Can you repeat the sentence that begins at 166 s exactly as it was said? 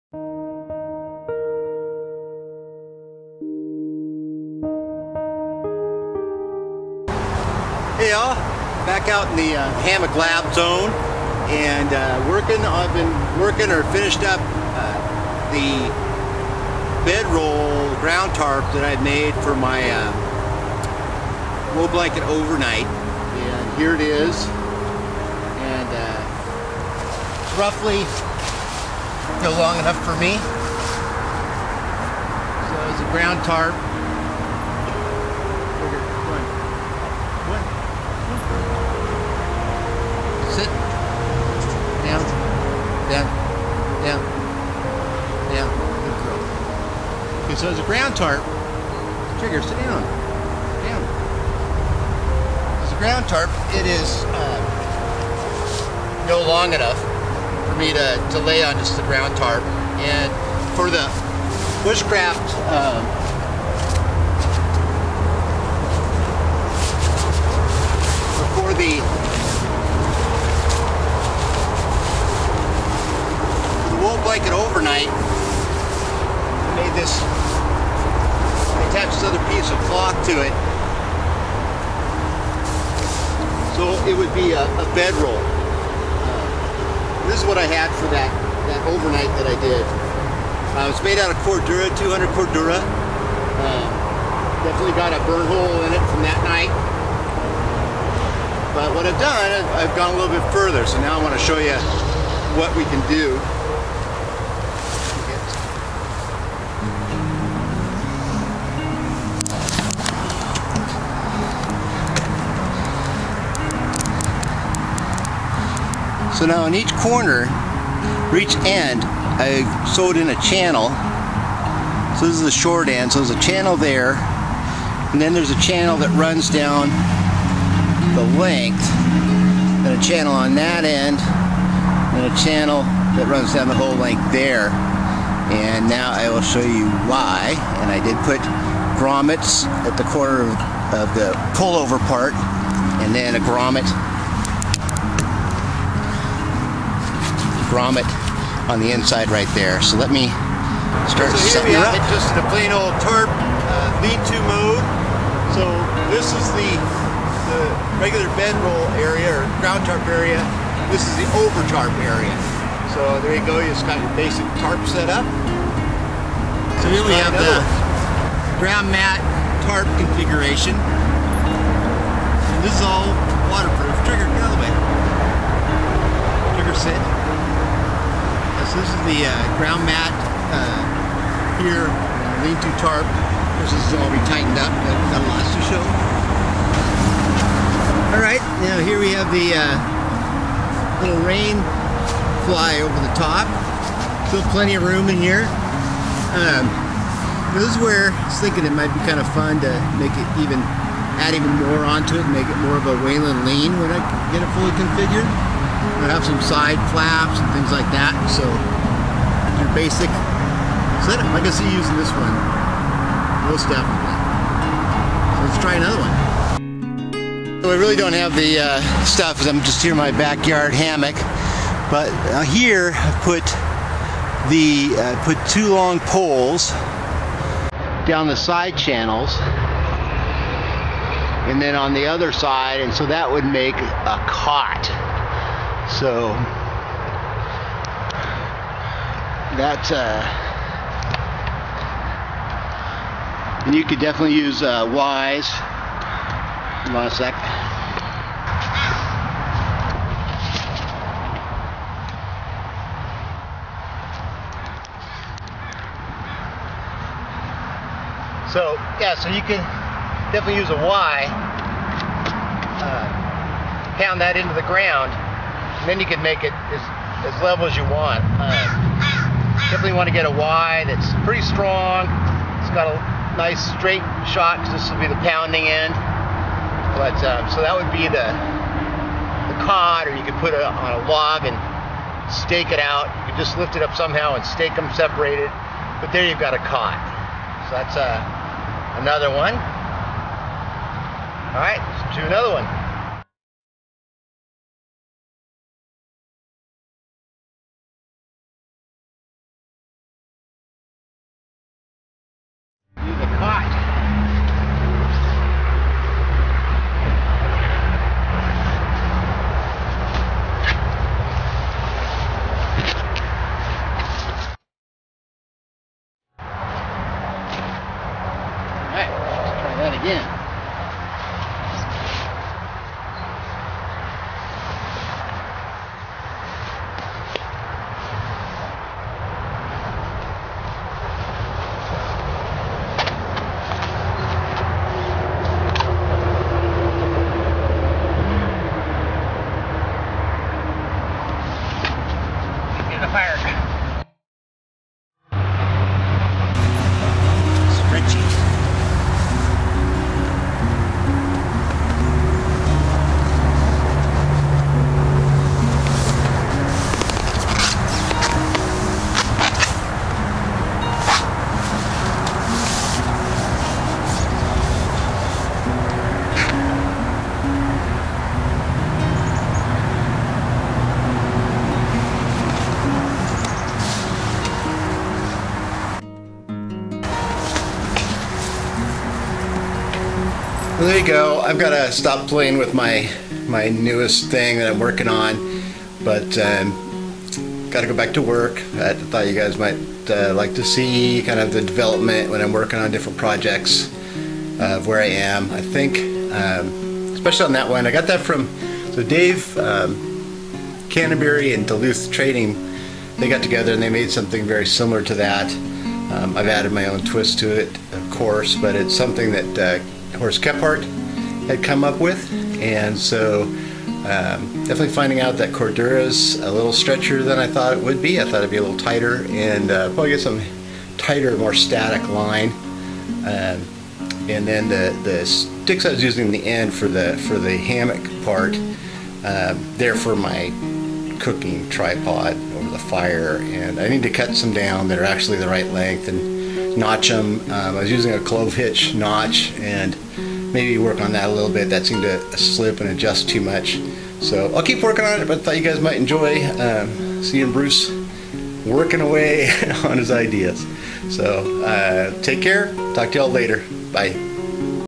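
So here we have the ground mat tarp configuration.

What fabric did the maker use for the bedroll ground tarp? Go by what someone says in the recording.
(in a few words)
200 Cordura.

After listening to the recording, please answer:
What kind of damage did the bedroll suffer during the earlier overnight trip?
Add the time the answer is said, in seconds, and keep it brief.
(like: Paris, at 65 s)
A burn hole, at 95 s.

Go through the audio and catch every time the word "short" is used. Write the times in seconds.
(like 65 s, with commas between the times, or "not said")
122 s.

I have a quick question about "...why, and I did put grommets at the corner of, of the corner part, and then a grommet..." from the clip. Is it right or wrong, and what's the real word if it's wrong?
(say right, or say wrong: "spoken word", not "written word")
wrong: "pullover", not "corner".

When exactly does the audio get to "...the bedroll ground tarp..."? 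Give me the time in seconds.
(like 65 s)
15 s.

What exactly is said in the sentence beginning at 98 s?
But what I've done, I've gone a little bit further.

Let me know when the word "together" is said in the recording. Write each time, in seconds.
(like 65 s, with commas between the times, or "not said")
403 s.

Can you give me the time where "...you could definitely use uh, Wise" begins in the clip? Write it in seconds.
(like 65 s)
243 s.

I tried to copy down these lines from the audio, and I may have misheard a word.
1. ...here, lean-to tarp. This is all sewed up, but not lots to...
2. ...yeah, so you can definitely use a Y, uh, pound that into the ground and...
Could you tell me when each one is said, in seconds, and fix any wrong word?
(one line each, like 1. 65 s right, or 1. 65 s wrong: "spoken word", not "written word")
1. 181 s wrong: "tightened", not "sewed"
2. 258 s right.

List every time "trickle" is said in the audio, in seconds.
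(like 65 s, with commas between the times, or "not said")
not said.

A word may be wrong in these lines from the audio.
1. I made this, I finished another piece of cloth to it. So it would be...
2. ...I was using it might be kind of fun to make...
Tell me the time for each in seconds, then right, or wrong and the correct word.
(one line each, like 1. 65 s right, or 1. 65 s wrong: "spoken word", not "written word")
1. 75 s wrong: "attached", not "finished"
2. 198 s wrong: "thinking", not "using".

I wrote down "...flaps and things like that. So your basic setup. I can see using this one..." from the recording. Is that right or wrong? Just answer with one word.
right.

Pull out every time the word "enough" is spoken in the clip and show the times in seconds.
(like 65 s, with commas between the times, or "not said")
29 s, 56 s.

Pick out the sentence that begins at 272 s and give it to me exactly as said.
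It's got a nice straight shot because this will be the pounding end.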